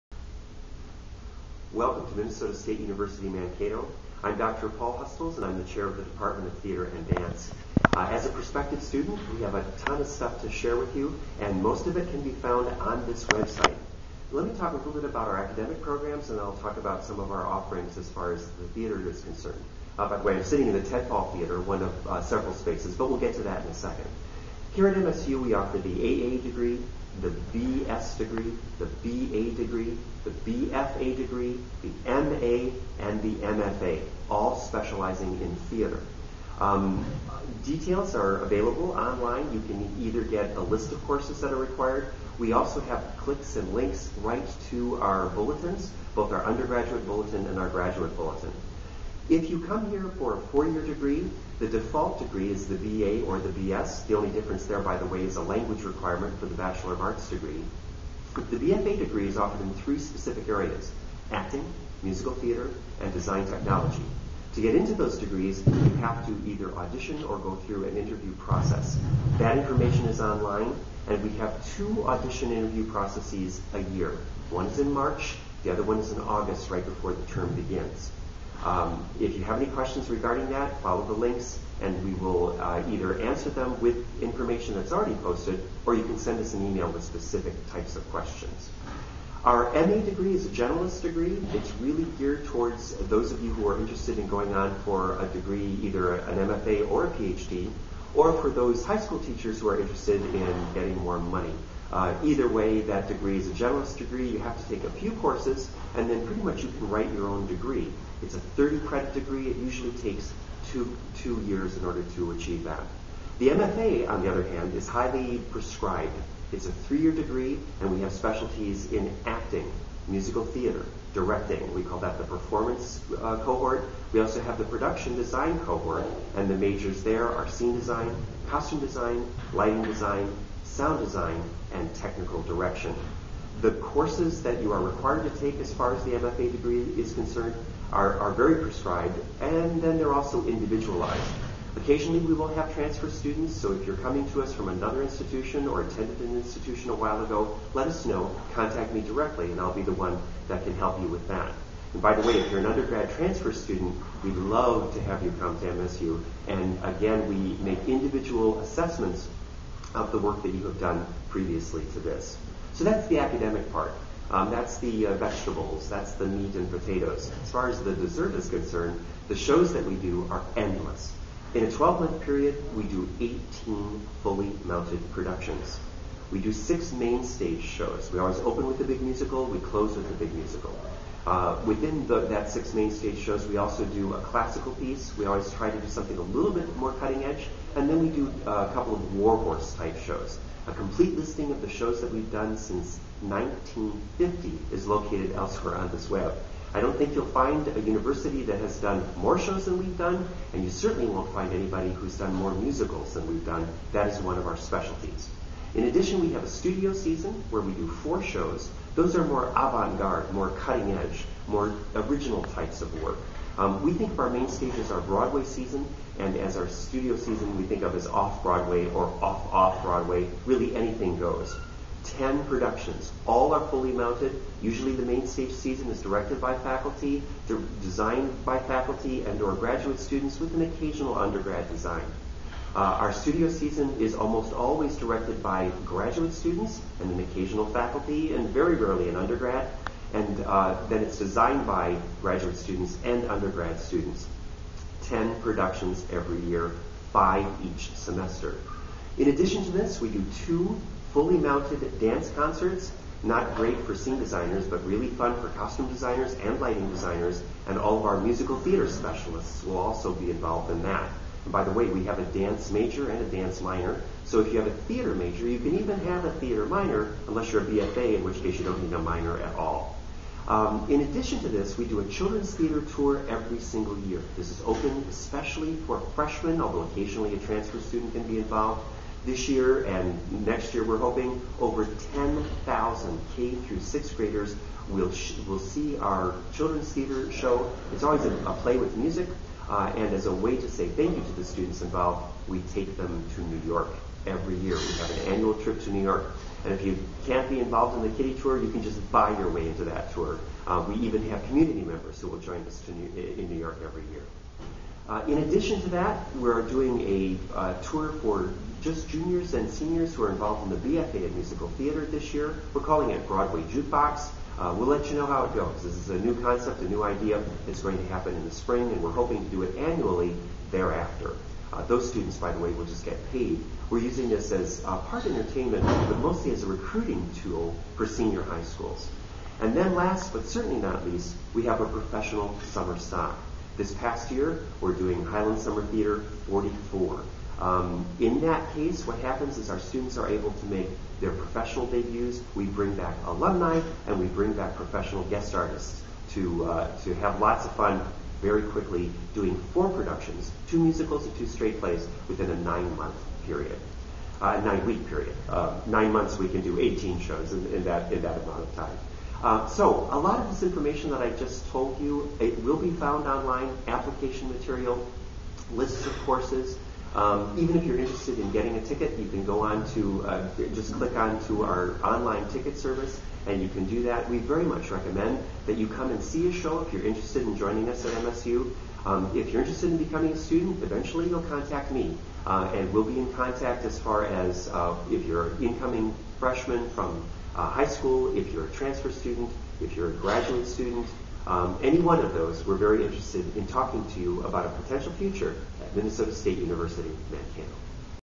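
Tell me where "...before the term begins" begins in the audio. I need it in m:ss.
1:16.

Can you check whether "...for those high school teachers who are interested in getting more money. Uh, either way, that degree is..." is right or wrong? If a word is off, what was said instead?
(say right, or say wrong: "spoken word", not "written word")
right.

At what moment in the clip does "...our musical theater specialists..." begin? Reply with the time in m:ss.
4:18.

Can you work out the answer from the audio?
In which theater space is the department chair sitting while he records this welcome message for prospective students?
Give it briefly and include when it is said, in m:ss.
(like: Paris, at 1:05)
Ted Paul Theater, at 0:20.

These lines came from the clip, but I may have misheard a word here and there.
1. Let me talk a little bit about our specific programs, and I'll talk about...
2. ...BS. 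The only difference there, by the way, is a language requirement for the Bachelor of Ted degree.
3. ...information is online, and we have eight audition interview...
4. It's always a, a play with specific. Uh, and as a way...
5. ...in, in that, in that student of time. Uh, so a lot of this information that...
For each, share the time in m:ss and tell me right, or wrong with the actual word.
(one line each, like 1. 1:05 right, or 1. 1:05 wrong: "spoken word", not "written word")
1. 0:14 wrong: "academic", not "specific"
2. 0:53 wrong: "Arts", not "Ted"
3. 1:09 wrong: "two", not "eight"
4. 4:47 wrong: "music", not "specific"
5. 5:57 wrong: "amount", not "student".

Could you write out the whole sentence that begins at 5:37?
Um, in that case, what happens is our students are able to make their professional debuts.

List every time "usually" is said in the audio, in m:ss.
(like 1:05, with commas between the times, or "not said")
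1:49, 3:44.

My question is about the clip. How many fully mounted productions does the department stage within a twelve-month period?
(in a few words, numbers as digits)
18.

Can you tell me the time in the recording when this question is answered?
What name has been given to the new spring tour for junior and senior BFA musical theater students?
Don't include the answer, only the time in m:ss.
5:13.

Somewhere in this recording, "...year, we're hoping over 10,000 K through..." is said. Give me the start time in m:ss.
4:40.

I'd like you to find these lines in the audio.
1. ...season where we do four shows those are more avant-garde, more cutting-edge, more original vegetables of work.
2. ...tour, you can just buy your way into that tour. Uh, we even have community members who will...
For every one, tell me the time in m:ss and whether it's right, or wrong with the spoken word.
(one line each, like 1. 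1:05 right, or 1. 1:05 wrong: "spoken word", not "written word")
1. 3:26 wrong: "types", not "vegetables"
2. 4:58 right.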